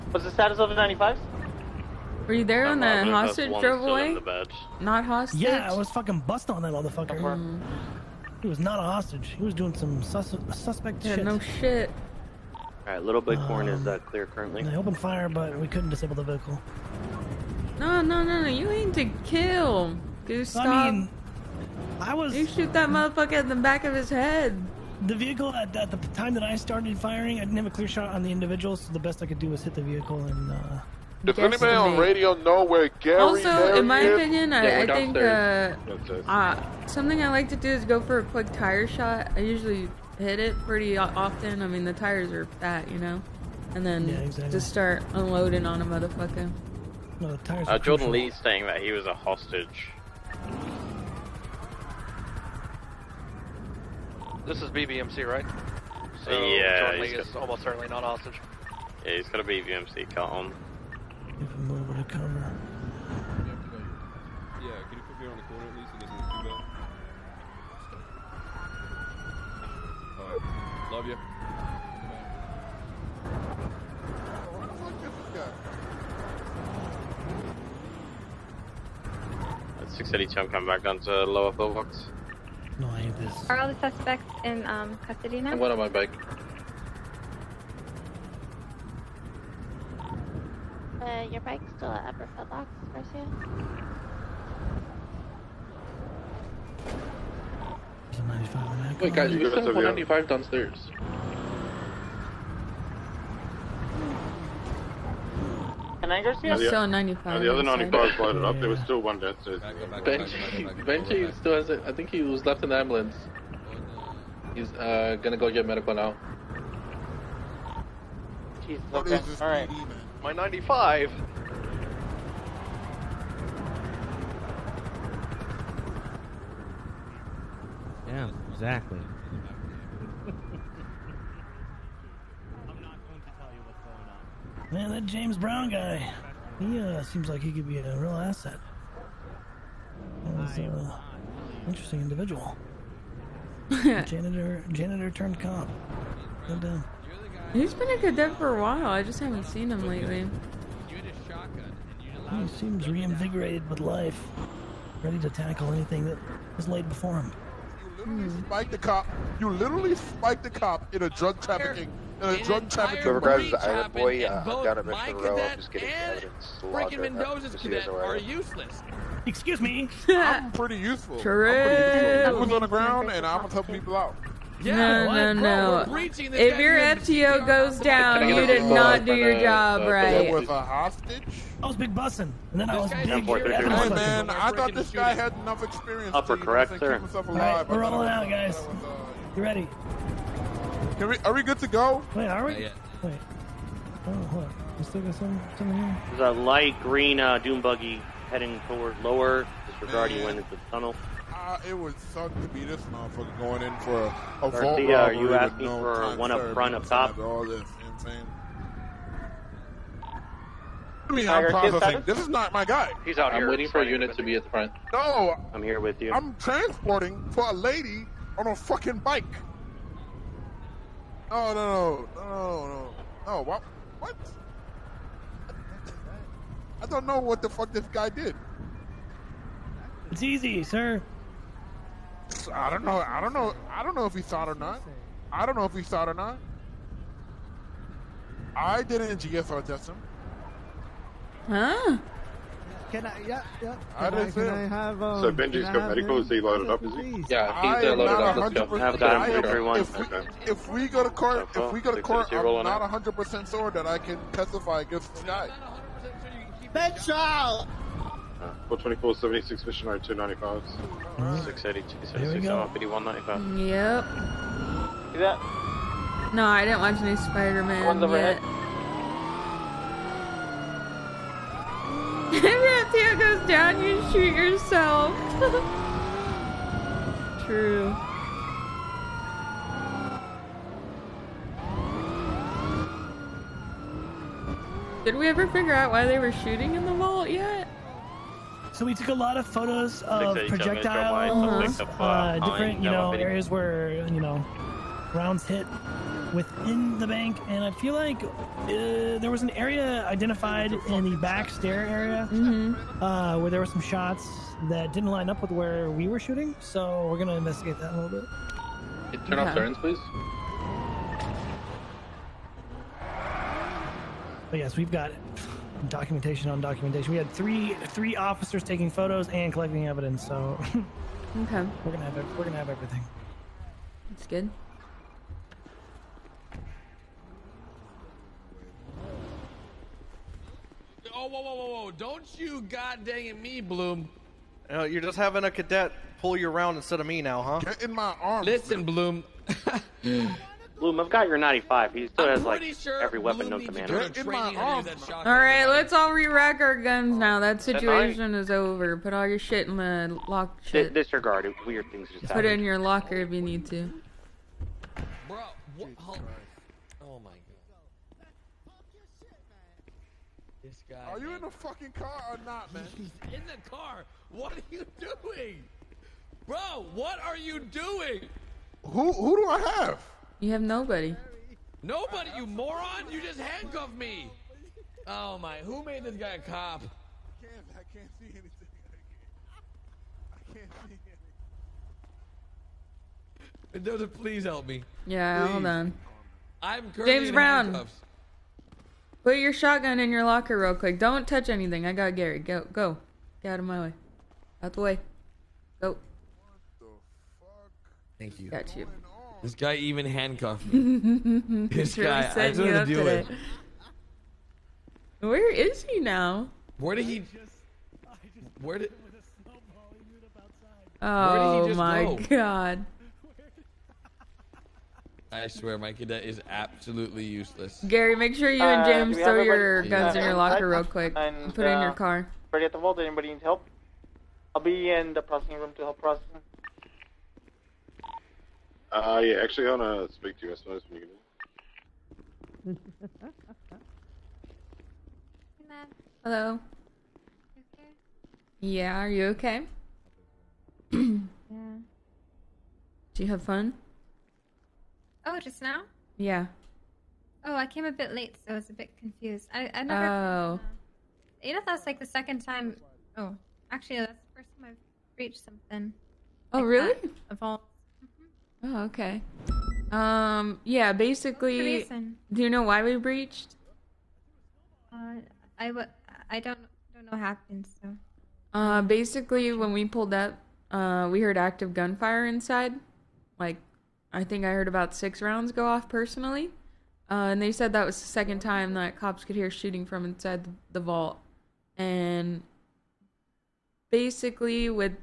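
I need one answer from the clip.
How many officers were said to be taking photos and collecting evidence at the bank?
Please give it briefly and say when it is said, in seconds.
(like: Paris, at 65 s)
3, at 317 s.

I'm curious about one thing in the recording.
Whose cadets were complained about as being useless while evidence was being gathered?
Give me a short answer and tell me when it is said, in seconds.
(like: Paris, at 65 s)
Mendoza, at 167 s.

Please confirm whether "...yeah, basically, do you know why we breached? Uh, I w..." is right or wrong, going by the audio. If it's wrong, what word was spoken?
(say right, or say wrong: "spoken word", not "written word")
right.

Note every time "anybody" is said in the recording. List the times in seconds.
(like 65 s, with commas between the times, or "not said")
31 s, 422 s.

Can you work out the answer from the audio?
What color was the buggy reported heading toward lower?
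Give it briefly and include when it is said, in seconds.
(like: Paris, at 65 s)
Light green, at 196 s.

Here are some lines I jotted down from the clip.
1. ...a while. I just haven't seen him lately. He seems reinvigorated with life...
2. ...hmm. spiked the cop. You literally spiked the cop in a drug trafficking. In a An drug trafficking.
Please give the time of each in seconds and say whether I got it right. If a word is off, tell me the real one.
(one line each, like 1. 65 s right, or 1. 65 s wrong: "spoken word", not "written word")
1. 148 s right
2. 158 s right.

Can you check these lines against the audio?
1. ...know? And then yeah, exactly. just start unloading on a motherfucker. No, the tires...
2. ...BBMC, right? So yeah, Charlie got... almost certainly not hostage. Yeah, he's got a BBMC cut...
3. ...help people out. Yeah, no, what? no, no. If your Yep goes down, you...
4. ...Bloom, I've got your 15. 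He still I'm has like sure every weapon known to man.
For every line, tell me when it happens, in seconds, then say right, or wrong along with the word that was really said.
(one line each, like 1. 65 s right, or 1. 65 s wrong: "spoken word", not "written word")
1. 42 s right
2. 54 s right
3. 173 s wrong: "FTO", not "Yep"
4. 340 s wrong: "95", not "15".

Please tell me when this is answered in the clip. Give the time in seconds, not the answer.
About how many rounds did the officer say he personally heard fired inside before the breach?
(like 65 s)
474 s.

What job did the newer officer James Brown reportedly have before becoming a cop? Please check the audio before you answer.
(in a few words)
Janitor.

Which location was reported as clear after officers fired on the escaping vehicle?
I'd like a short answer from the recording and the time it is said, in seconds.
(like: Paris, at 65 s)
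Little Bighorn, at 13 s.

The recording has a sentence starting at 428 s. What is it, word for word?
Uh, yeah, actually, I want to speak to you, I suppose, when you can.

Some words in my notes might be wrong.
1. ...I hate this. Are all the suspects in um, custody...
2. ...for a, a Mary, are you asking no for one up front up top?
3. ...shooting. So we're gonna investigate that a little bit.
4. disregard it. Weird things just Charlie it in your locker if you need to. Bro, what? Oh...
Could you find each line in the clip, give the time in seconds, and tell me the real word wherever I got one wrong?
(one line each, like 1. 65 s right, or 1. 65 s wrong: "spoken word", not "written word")
1. 82 s right
2. 203 s wrong: "Garcia", not "Mary"
3. 306 s right
4. 350 s wrong: "Put", not "Charlie".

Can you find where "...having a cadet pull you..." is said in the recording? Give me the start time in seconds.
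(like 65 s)
335 s.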